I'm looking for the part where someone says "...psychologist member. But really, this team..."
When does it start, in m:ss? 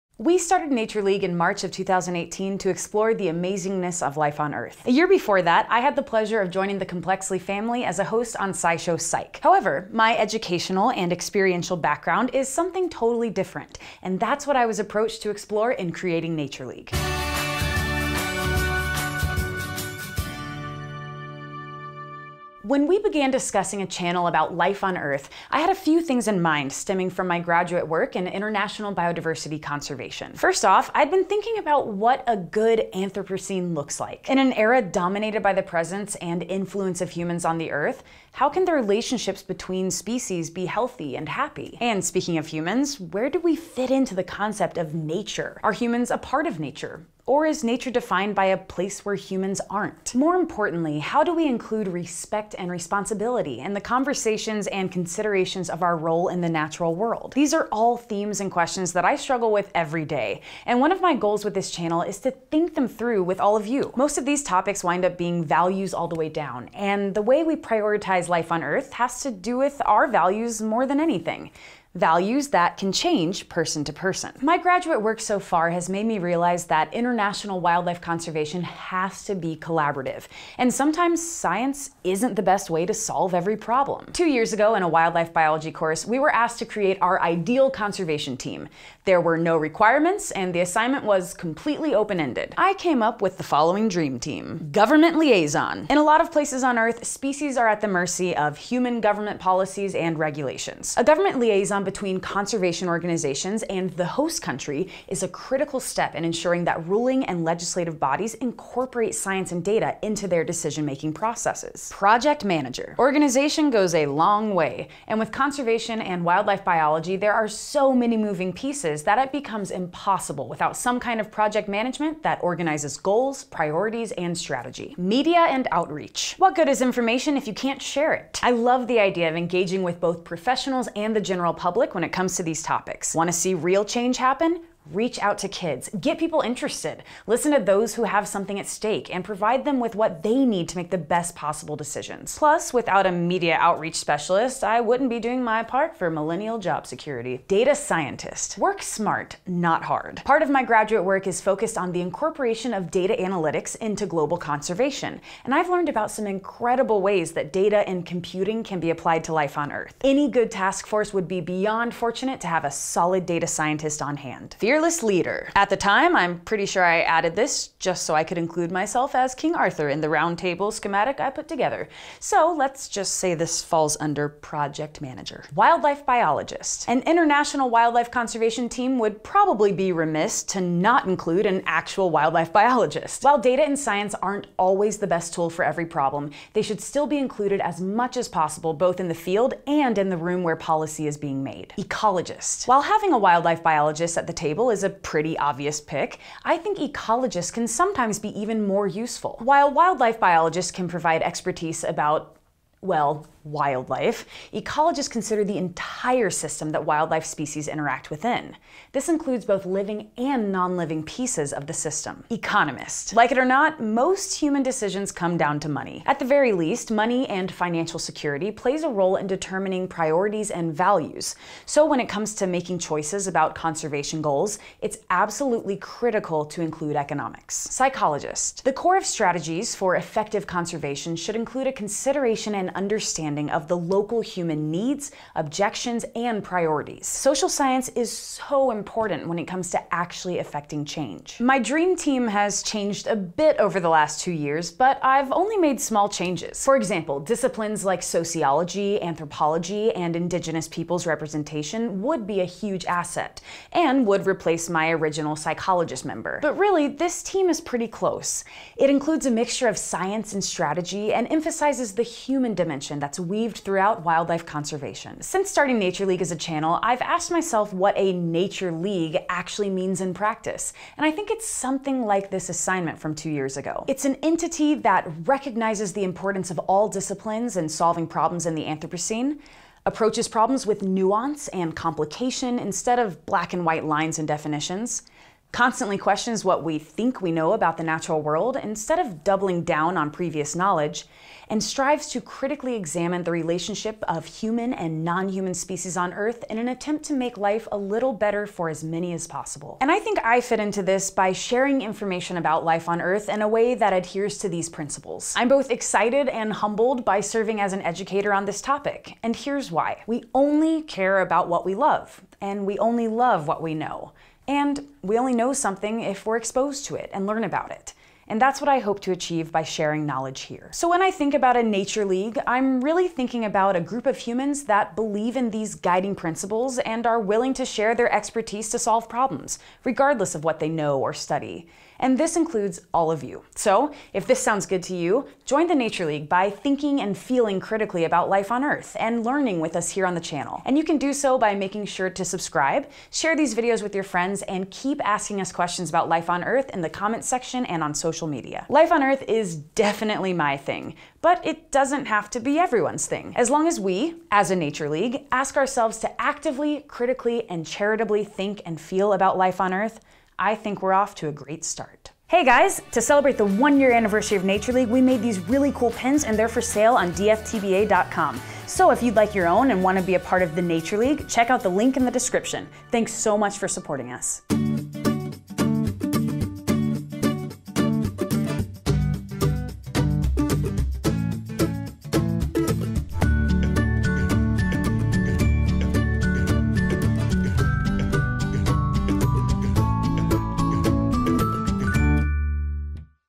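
4:15.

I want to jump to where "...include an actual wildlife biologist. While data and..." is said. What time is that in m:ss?
3:01.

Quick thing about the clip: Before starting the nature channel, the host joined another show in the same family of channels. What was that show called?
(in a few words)
SciShow Psych.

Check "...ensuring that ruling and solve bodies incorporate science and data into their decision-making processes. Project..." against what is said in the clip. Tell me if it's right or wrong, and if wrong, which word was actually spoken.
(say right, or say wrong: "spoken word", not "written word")
wrong: "legislative", not "solve".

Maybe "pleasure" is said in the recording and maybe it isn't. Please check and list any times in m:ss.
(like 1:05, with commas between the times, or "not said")
0:06.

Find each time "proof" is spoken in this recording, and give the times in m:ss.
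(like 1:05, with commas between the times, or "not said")
not said.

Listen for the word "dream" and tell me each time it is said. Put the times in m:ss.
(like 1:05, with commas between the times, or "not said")
1:33, 4:01.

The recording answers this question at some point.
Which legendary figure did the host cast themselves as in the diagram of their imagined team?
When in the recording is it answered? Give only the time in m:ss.
2:49.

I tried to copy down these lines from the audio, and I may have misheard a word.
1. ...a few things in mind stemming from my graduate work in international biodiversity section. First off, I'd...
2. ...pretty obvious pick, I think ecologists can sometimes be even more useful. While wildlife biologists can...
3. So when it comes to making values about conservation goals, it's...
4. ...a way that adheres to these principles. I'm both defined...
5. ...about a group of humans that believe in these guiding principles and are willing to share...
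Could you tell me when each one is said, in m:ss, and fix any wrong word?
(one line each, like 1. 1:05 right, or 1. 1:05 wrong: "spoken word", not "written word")
1. 0:25 wrong: "conservation", not "section"
2. 3:14 right
3. 3:41 wrong: "choices", not "values"
4. 5:03 wrong: "excited", not "defined"
5. 5:23 right.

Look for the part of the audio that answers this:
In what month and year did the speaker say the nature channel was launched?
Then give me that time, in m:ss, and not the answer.
0:01.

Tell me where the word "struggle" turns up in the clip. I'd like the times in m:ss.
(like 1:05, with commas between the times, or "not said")
0:59.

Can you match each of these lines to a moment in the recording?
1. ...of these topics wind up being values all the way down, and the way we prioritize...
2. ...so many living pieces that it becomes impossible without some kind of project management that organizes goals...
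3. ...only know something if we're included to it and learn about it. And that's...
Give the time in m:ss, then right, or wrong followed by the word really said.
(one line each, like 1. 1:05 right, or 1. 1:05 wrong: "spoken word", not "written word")
1. 1:04 right
2. 1:57 wrong: "moving", not "living"
3. 5:15 wrong: "exposed", not "included".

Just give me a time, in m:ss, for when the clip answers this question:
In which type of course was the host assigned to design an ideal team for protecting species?
1:24.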